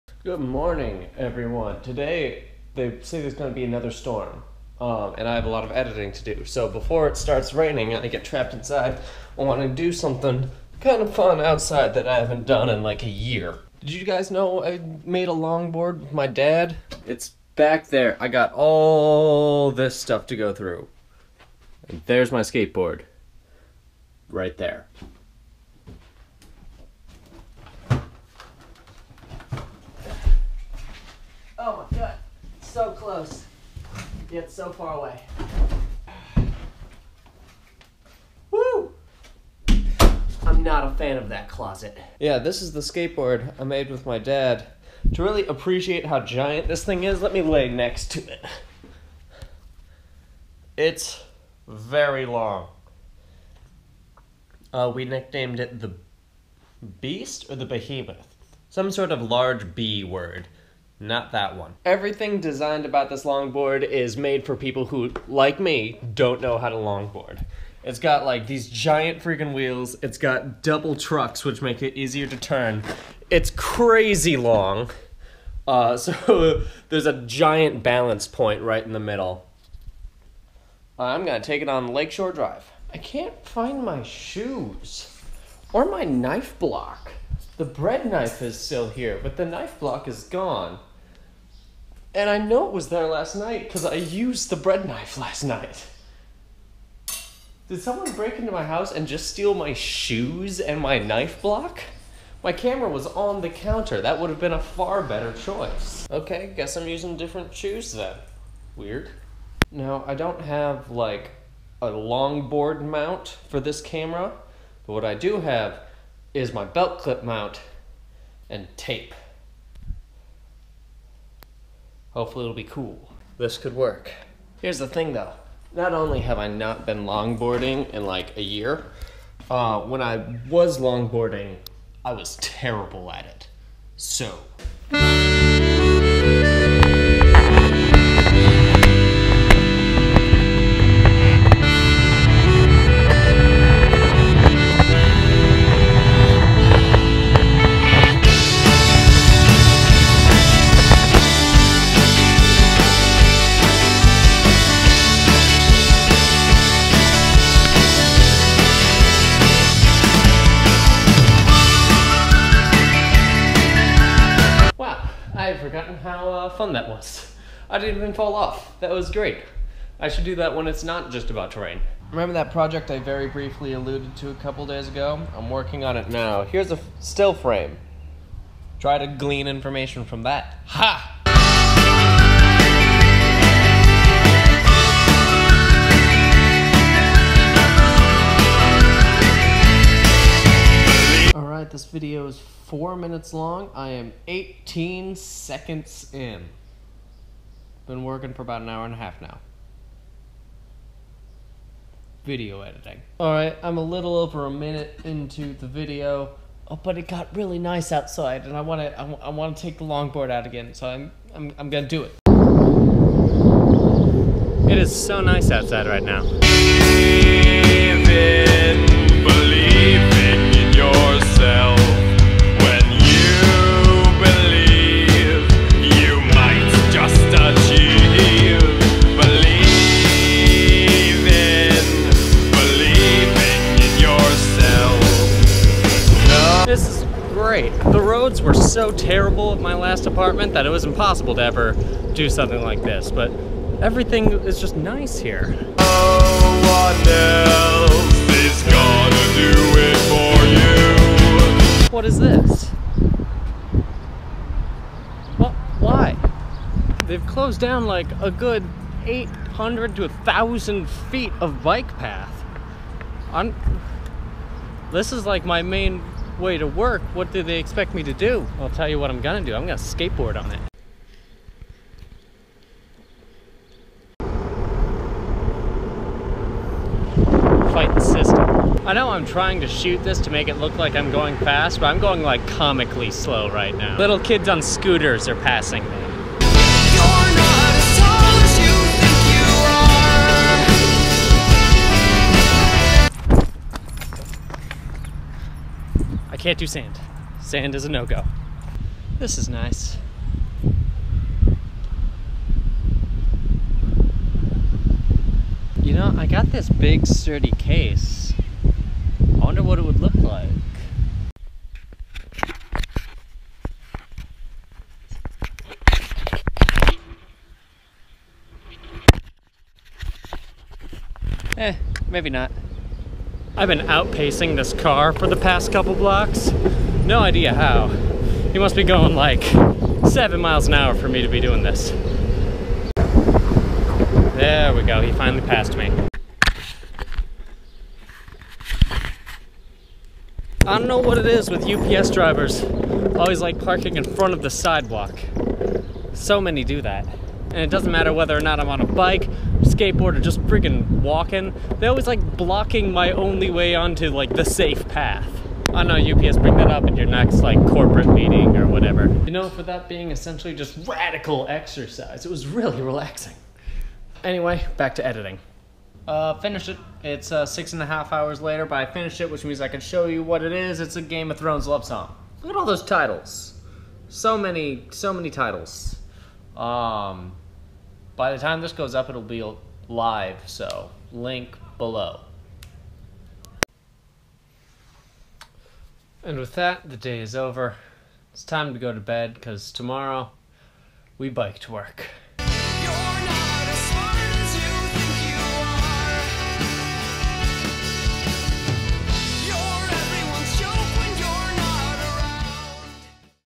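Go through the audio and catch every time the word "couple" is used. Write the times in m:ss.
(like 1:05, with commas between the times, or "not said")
2:54, 5:25.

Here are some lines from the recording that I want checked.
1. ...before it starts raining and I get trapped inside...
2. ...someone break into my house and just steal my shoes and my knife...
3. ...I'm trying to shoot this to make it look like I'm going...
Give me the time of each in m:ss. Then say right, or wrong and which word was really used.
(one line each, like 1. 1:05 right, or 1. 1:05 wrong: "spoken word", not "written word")
1. 0:06 right
2. 1:37 right
3. 4:39 right.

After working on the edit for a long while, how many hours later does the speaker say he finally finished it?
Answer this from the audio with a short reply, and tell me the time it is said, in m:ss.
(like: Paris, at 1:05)
6 and a half hours, at 6:07.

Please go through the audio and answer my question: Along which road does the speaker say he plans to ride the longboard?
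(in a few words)
Lakeshore Drive.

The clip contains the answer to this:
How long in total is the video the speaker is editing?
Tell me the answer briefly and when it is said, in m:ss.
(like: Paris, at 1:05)
4 minutes, at 3:12.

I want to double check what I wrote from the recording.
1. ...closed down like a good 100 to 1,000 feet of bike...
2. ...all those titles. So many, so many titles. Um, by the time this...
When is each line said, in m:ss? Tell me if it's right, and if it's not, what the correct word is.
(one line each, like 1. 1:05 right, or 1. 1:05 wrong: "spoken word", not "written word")
1. 4:17 wrong: "800", not "100"
2. 6:12 right.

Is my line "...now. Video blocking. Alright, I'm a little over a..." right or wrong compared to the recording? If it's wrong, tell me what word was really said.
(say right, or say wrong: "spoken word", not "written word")
wrong: "editing", not "blocking".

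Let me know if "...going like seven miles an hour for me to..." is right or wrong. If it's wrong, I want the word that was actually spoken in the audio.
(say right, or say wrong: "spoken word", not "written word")
right.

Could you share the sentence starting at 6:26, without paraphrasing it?
And with that, the day is over.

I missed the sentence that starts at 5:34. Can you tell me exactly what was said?
There we go, he finally passed me.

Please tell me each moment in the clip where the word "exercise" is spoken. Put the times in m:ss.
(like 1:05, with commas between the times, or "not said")
6:01.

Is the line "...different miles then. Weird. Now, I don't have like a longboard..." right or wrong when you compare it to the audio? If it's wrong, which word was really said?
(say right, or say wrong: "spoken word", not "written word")
wrong: "shoes", not "miles".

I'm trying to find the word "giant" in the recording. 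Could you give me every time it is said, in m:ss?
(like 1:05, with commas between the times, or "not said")
0:46, 1:08, 1:17.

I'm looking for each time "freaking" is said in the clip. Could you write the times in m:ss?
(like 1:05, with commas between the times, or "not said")
1:09, 5:50.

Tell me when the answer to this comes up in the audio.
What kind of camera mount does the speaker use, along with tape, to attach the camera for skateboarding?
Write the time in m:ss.
1:56.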